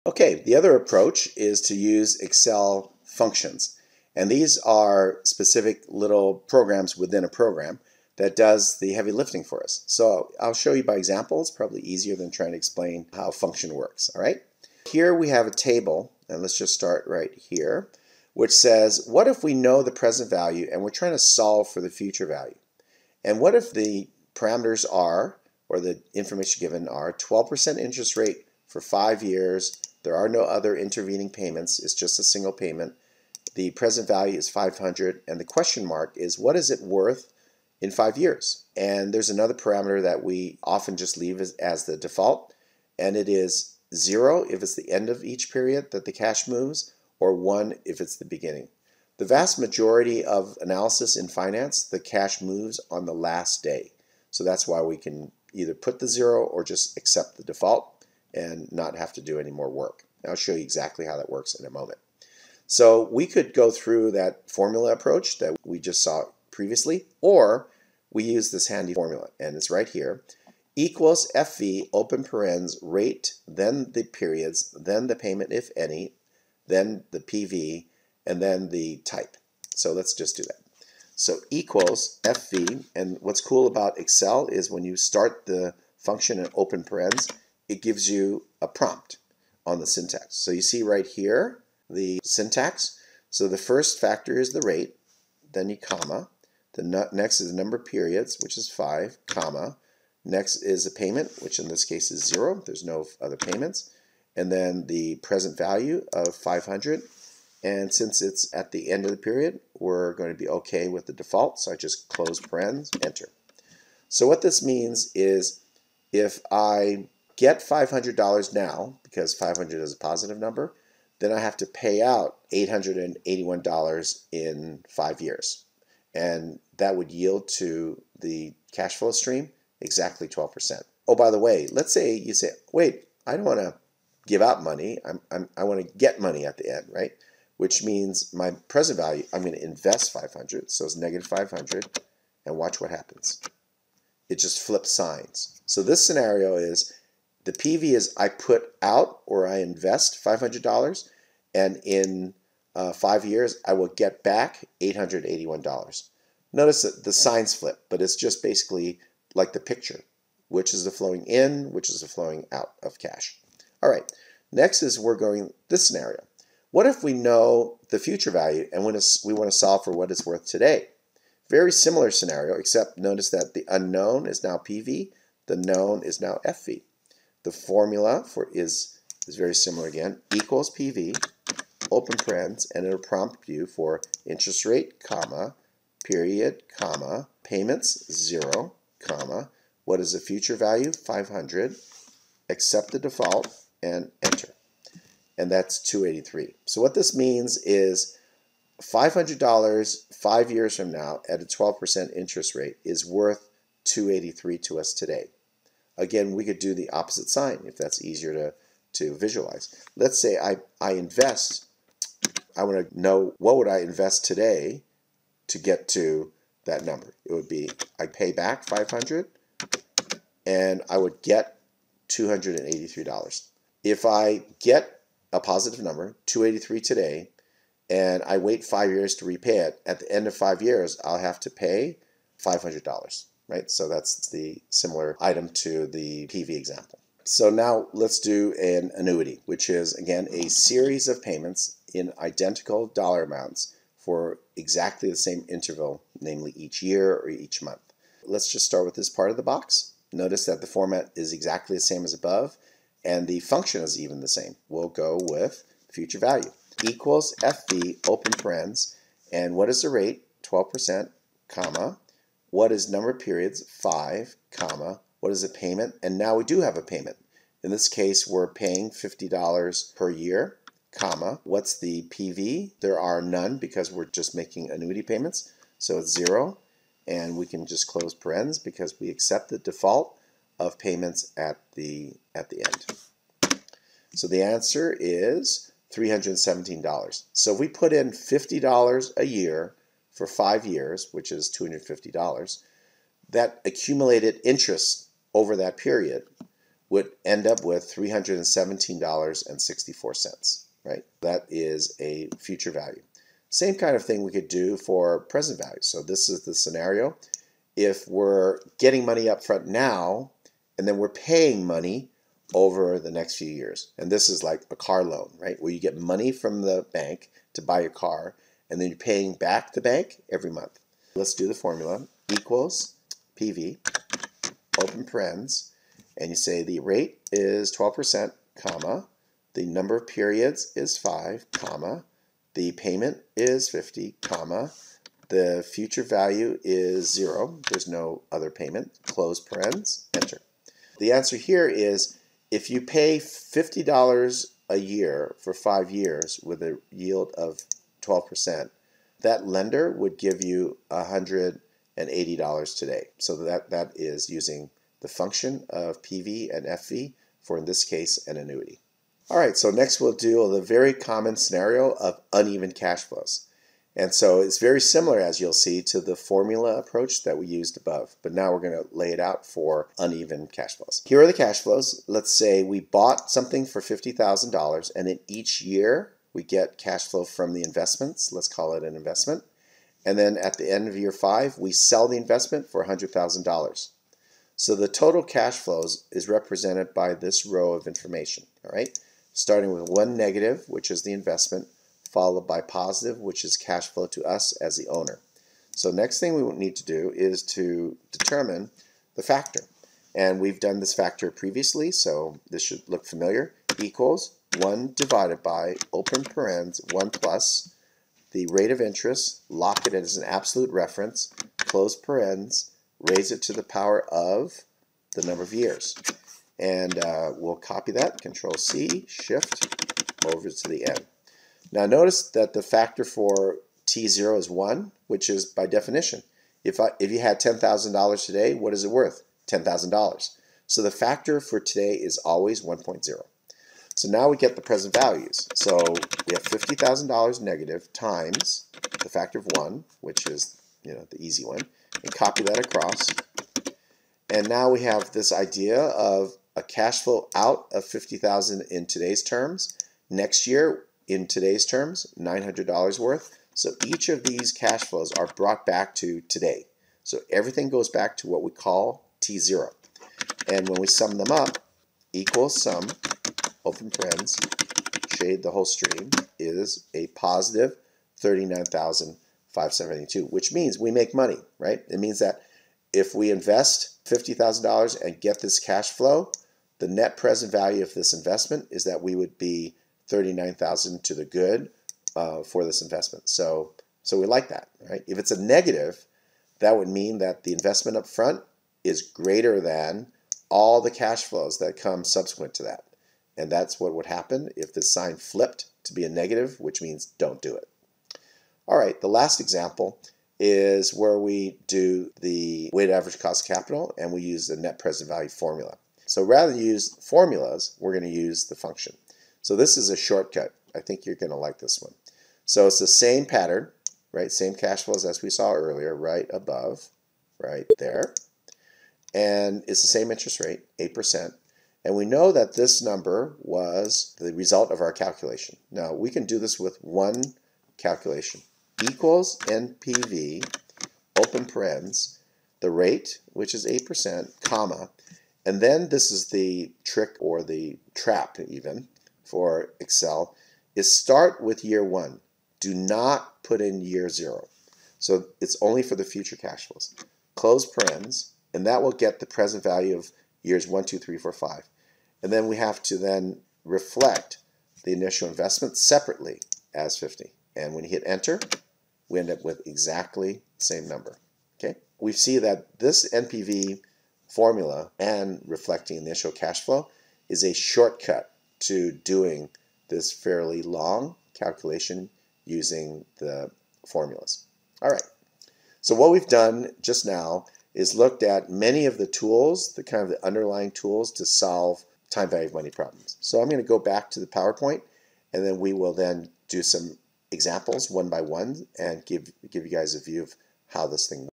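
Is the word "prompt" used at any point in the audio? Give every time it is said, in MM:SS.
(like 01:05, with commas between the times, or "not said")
01:28, 03:02.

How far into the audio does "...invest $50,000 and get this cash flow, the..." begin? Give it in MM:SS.
07:53.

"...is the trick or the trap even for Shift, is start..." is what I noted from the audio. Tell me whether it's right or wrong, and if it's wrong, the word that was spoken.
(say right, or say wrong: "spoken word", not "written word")
wrong: "Excel", not "Shift".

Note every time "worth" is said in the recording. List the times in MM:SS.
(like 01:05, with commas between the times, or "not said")
00:36, 02:50, 03:23, 07:08, 07:32.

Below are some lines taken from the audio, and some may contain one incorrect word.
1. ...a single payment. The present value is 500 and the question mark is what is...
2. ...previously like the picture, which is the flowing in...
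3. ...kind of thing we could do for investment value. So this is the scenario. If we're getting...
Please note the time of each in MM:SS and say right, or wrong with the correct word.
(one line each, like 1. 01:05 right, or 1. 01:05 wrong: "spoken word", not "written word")
1. 00:32 right
2. 02:38 wrong: "basically", not "previously"
3. 05:03 wrong: "present", not "investment".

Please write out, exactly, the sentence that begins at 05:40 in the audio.
The answer here is if you pay $50 a year for five years with a yield of 12%.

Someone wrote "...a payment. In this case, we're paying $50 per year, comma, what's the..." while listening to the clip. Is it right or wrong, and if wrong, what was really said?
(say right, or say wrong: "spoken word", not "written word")
right.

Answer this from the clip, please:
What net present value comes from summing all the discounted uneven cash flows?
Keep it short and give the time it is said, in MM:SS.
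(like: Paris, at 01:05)
39,572, at 07:48.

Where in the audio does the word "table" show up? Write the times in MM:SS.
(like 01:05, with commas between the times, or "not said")
00:15.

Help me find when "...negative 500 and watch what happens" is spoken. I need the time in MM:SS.
02:20.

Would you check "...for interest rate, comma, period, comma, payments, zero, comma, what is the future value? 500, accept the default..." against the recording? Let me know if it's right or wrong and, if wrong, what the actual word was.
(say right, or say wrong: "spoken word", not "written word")
right.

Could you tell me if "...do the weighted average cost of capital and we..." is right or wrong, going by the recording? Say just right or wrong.
right.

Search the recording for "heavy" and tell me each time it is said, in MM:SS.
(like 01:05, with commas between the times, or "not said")
00:08.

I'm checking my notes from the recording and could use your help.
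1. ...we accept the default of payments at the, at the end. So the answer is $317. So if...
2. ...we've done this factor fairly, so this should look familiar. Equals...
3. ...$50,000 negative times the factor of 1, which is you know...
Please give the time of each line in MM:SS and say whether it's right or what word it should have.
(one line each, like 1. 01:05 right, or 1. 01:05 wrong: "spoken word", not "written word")
1. 04:38 right
2. 06:40 wrong: "previously", not "fairly"
3. 07:16 right.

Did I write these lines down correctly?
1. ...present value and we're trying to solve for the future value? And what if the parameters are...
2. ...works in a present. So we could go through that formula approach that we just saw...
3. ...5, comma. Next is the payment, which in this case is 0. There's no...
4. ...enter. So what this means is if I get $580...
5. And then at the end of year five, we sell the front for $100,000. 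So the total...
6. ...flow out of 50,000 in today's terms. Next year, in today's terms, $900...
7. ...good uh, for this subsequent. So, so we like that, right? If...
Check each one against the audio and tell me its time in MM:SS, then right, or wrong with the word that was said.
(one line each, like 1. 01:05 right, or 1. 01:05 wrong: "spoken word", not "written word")
1. 00:19 right
2. 01:01 wrong: "moment", not "present"
3. 01:38 right
4. 01:53 wrong: "500", not "580"
5. 06:20 wrong: "investment", not "front"
6. 07:27 right
7. 08:01 wrong: "investment", not "subsequent".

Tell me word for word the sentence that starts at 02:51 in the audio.
Very similar scenario, except notice that the unknown is now PV, the known is now FV.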